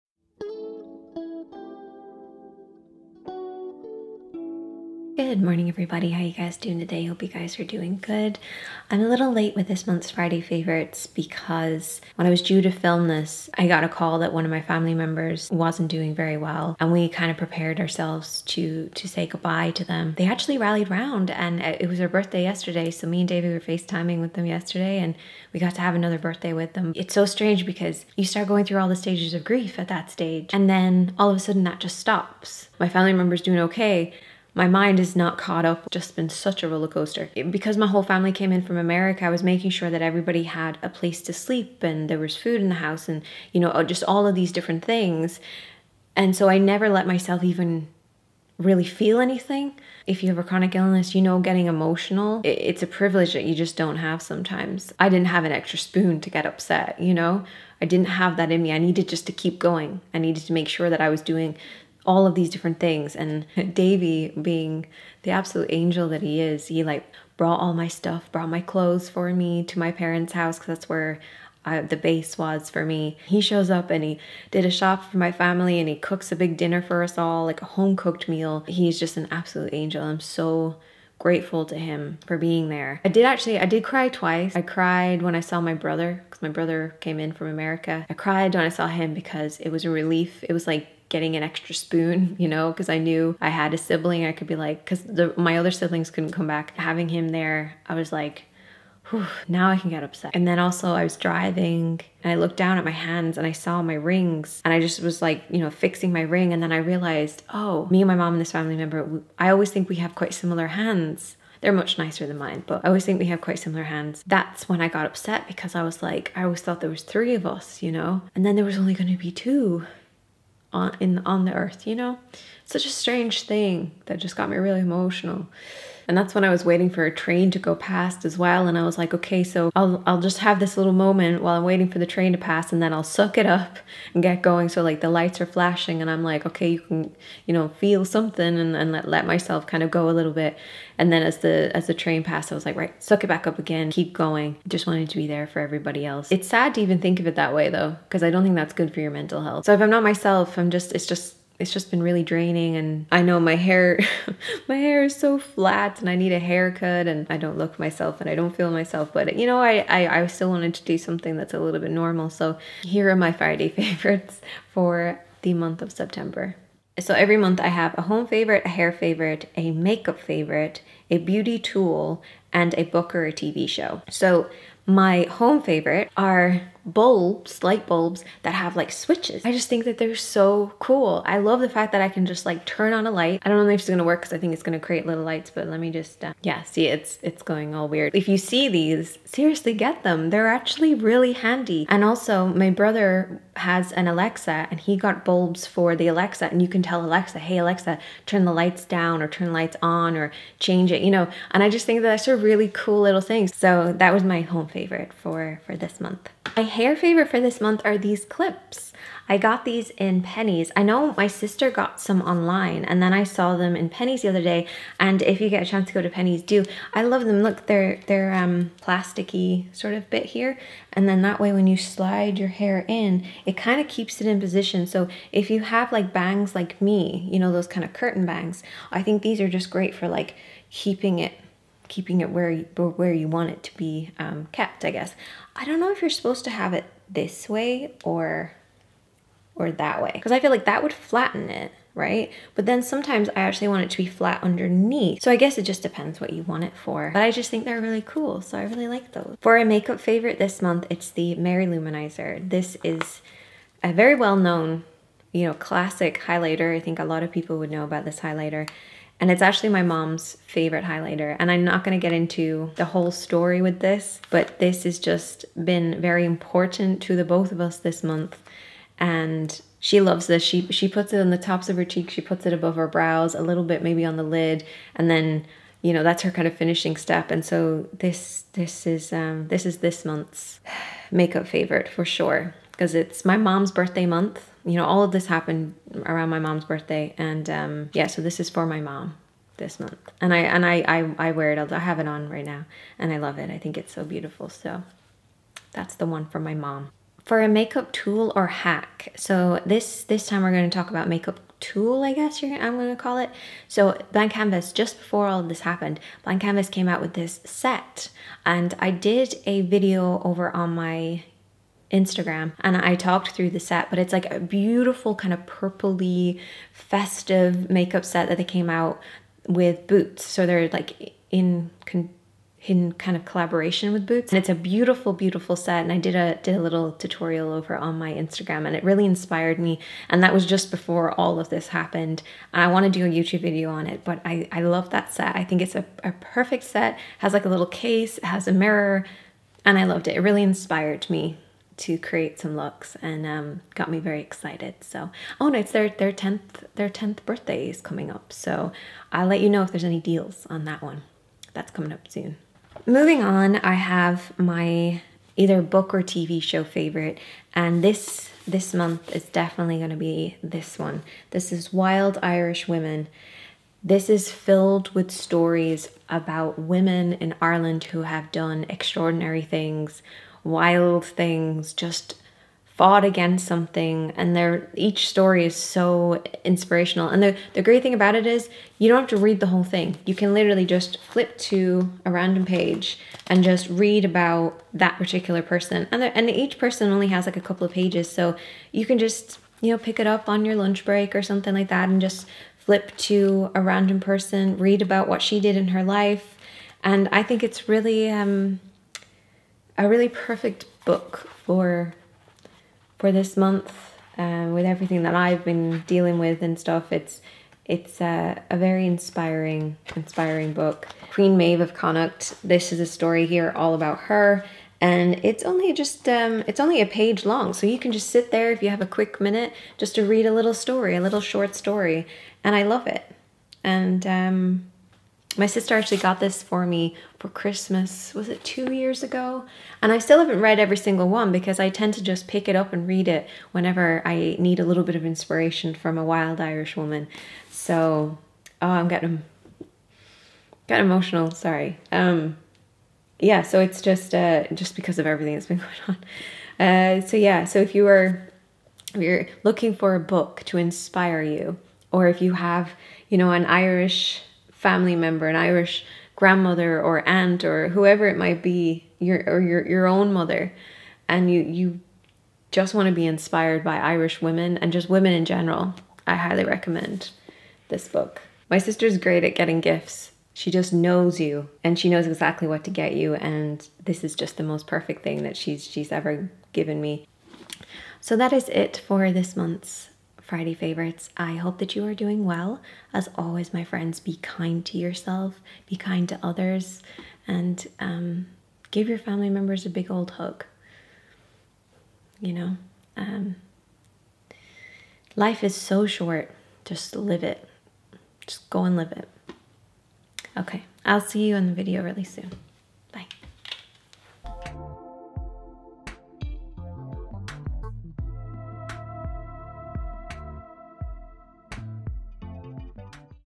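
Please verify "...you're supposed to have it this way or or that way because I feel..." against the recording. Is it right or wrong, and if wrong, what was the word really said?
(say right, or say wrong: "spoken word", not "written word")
right.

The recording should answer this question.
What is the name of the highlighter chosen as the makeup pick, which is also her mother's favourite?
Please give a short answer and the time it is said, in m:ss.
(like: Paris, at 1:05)
Mary-Lou Manizer, at 4:11.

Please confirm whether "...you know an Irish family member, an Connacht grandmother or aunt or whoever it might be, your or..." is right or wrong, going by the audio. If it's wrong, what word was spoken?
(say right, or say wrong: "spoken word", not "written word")
wrong: "Irish", not "Connacht".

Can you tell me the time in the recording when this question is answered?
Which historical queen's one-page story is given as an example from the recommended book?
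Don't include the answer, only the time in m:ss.
6:51.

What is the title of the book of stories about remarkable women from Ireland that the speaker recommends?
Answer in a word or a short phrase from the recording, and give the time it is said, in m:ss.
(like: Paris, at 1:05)
Wild Irish Women, at 6:01.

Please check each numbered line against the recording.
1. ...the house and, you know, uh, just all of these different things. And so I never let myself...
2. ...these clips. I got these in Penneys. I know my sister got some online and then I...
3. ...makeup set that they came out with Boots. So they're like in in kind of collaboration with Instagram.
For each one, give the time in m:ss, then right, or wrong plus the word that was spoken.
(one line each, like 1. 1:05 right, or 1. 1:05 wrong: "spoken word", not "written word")
1. 0:42 right
2. 3:27 right
3. 5:17 wrong: "Boots", not "Instagram".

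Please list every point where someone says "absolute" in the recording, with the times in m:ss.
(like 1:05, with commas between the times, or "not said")
1:05, 1:19.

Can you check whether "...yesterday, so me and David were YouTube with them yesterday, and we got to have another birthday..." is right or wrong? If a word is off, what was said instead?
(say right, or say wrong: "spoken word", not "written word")
wrong: "FaceTiming", not "YouTube".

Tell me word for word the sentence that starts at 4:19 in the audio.
And it's actually my mom's favorite highlighter.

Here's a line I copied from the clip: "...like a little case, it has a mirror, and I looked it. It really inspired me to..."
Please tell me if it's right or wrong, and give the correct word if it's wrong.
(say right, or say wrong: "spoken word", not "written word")
wrong: "loved", not "looked".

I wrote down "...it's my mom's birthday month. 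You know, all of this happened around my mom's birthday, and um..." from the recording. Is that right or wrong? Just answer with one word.
right.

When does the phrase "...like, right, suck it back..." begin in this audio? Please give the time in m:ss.
2:22.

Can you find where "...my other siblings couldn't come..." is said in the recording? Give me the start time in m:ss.
1:35.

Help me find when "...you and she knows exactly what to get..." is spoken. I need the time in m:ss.
7:51.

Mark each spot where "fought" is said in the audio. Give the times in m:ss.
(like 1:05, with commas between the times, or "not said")
6:12.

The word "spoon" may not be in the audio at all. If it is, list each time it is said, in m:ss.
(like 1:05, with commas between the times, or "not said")
0:55, 1:31.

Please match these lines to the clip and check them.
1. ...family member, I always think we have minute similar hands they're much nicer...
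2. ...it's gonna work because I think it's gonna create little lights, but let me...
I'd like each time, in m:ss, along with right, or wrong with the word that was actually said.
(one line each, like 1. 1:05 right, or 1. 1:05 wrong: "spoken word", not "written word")
1. 1:48 wrong: "quite", not "minute"
2. 3:03 right.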